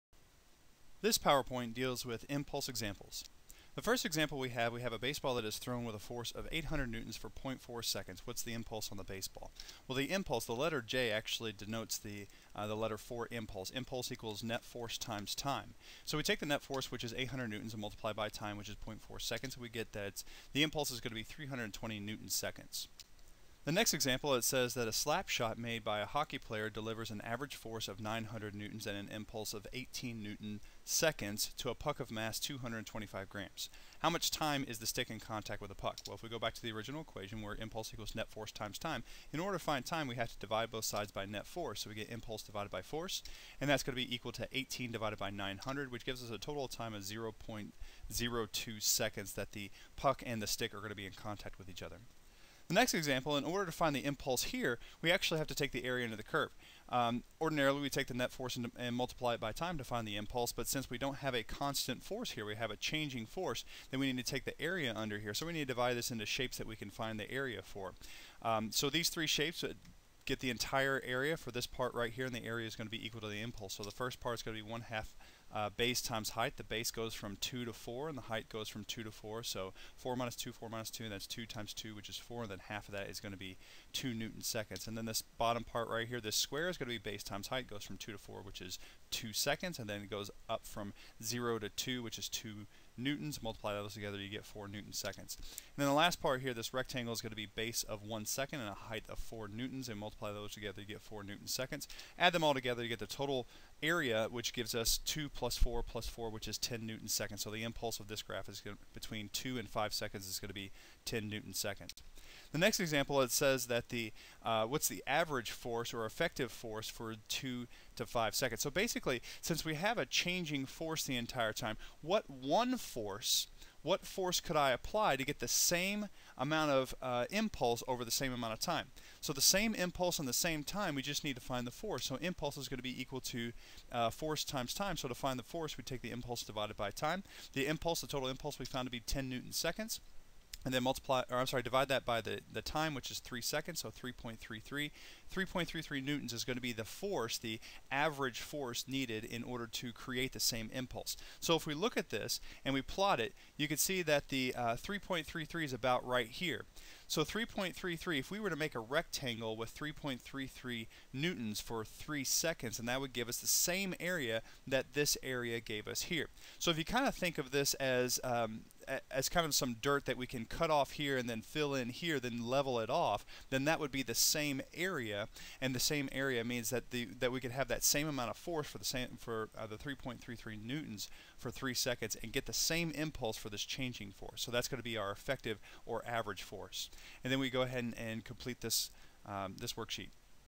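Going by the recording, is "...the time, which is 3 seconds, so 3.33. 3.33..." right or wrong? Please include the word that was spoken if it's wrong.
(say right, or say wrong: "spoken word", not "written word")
right.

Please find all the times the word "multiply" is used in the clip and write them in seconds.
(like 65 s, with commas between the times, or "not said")
17 s, 58 s, 93 s, 99 s, 140 s.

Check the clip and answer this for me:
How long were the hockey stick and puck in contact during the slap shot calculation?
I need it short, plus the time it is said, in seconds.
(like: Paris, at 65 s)
0.02 seconds, at 47 s.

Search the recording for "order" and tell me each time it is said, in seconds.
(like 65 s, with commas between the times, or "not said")
39 s, 53 s, 149 s.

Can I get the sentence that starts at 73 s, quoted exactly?
So the first part is going to be 1 half uh, base times height.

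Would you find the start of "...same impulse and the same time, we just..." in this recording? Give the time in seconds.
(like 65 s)
129 s.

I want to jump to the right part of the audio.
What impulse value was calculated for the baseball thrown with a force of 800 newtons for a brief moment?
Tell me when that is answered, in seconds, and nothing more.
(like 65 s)
21 s.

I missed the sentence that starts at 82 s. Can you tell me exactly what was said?
And then half of that is going to be 2 newton seconds.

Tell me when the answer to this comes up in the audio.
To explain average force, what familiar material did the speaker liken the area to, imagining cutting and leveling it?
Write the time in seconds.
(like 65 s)
169 s.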